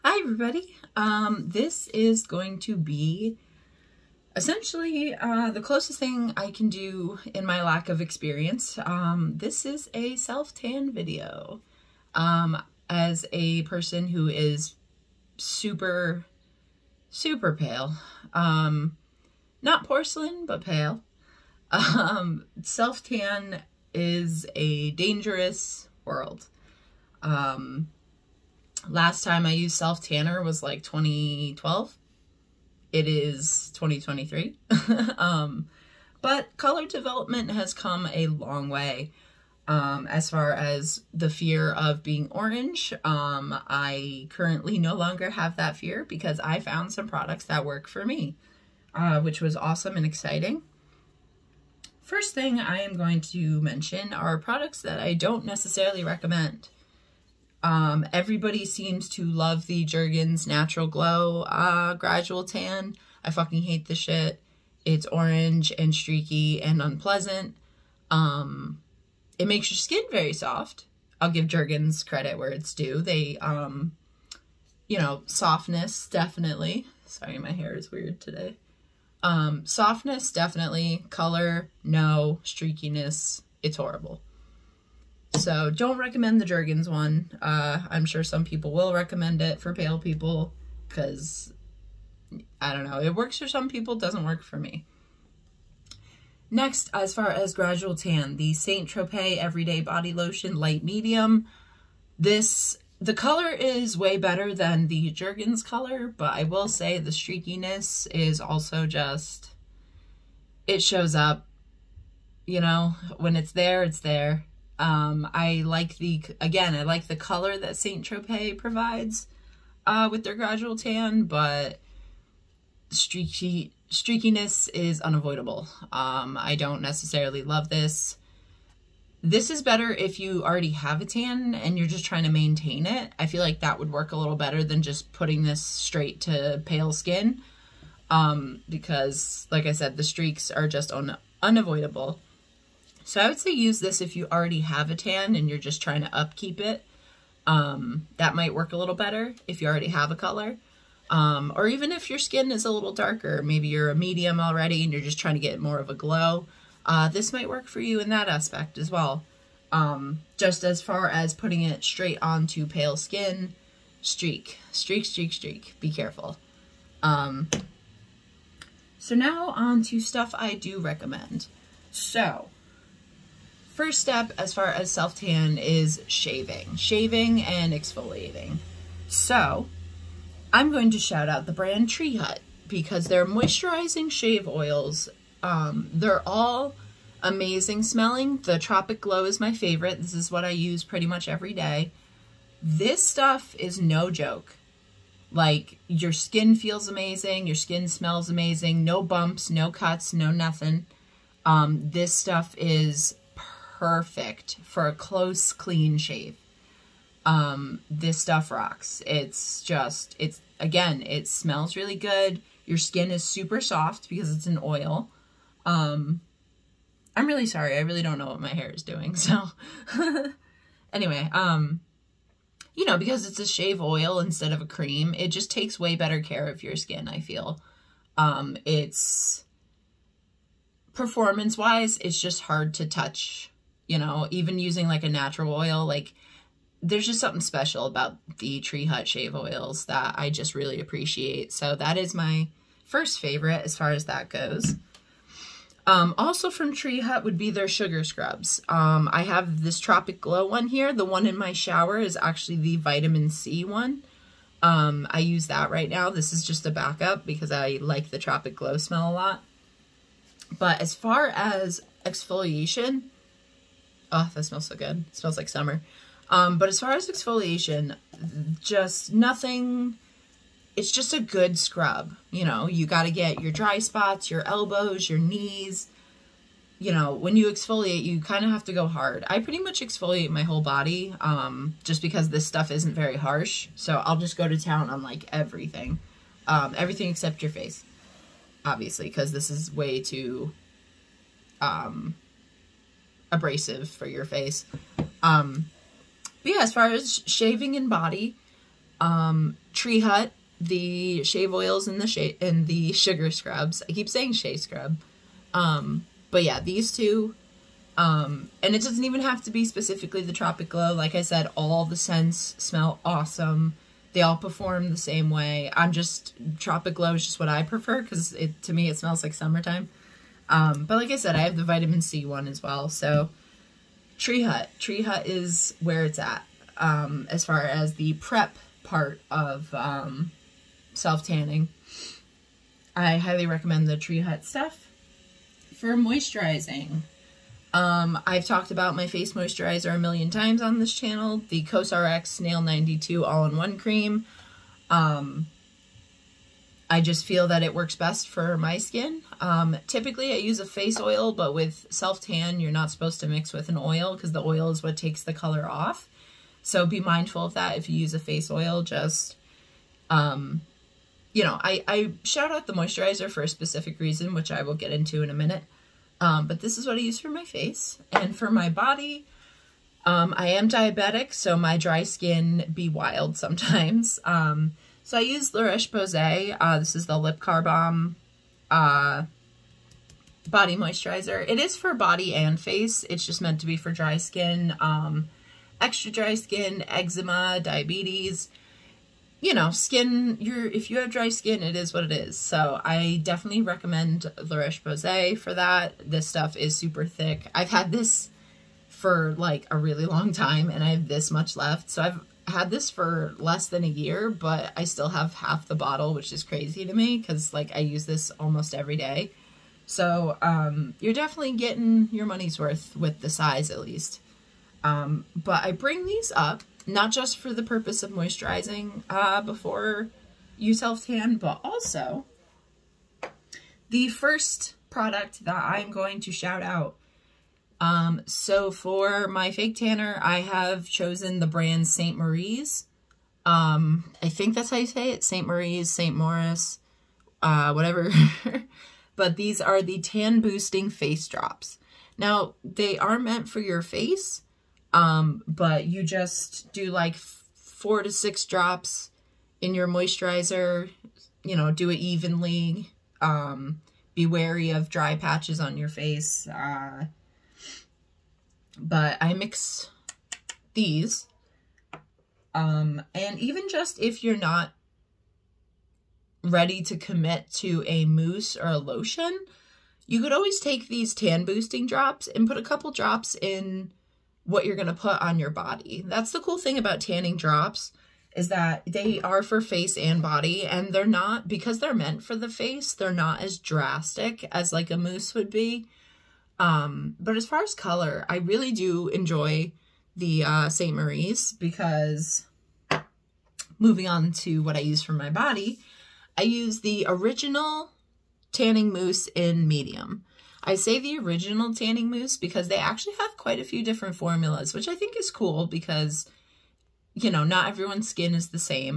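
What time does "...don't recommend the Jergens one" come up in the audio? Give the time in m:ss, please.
1:25.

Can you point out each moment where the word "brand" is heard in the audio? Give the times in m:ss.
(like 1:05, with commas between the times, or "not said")
3:01, 7:11.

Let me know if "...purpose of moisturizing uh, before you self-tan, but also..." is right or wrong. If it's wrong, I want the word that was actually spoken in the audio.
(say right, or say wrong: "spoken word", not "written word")
right.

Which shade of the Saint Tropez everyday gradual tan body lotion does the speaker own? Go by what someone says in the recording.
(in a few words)
Light Medium.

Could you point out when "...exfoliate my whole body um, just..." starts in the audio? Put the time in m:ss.
4:39.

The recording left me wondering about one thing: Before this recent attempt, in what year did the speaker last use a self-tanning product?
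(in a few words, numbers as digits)
2012.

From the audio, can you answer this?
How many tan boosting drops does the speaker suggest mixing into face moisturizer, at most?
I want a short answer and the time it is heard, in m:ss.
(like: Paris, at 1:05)
6, at 7:28.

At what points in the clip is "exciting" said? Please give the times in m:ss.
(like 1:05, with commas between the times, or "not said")
0:50.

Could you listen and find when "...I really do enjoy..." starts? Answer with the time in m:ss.
8:08.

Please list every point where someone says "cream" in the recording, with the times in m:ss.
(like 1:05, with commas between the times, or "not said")
3:44, 5:43.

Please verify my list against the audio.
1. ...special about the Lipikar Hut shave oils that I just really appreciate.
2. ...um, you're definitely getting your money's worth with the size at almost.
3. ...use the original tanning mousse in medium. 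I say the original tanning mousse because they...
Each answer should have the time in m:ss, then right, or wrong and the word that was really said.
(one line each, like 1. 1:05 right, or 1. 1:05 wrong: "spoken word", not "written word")
1. 3:57 wrong: "Tree", not "Lipikar"
2. 6:50 wrong: "least", not "almost"
3. 8:16 right.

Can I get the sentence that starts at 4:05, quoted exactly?
Um, also from Tree Hut would be their sugar scrubs.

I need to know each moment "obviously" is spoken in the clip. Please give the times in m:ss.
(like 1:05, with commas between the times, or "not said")
4:48.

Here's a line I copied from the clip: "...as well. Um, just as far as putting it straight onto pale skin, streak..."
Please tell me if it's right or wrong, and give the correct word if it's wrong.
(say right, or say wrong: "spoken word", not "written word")
right.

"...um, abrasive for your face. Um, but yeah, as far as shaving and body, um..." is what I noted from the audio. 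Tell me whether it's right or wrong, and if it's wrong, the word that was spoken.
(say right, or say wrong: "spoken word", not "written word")
right.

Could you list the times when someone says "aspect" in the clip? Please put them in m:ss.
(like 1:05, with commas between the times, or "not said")
2:38.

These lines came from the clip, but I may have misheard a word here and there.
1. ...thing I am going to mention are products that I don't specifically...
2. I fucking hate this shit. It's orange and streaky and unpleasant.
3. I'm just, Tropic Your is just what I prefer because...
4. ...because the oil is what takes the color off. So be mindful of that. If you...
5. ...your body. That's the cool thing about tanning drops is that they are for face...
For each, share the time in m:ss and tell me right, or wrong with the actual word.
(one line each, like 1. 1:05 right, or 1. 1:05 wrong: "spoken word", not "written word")
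1. 0:52 wrong: "necessarily", not "specifically"
2. 1:03 right
3. 5:15 wrong: "Glow", not "Your"
4. 5:54 right
5. 7:55 right.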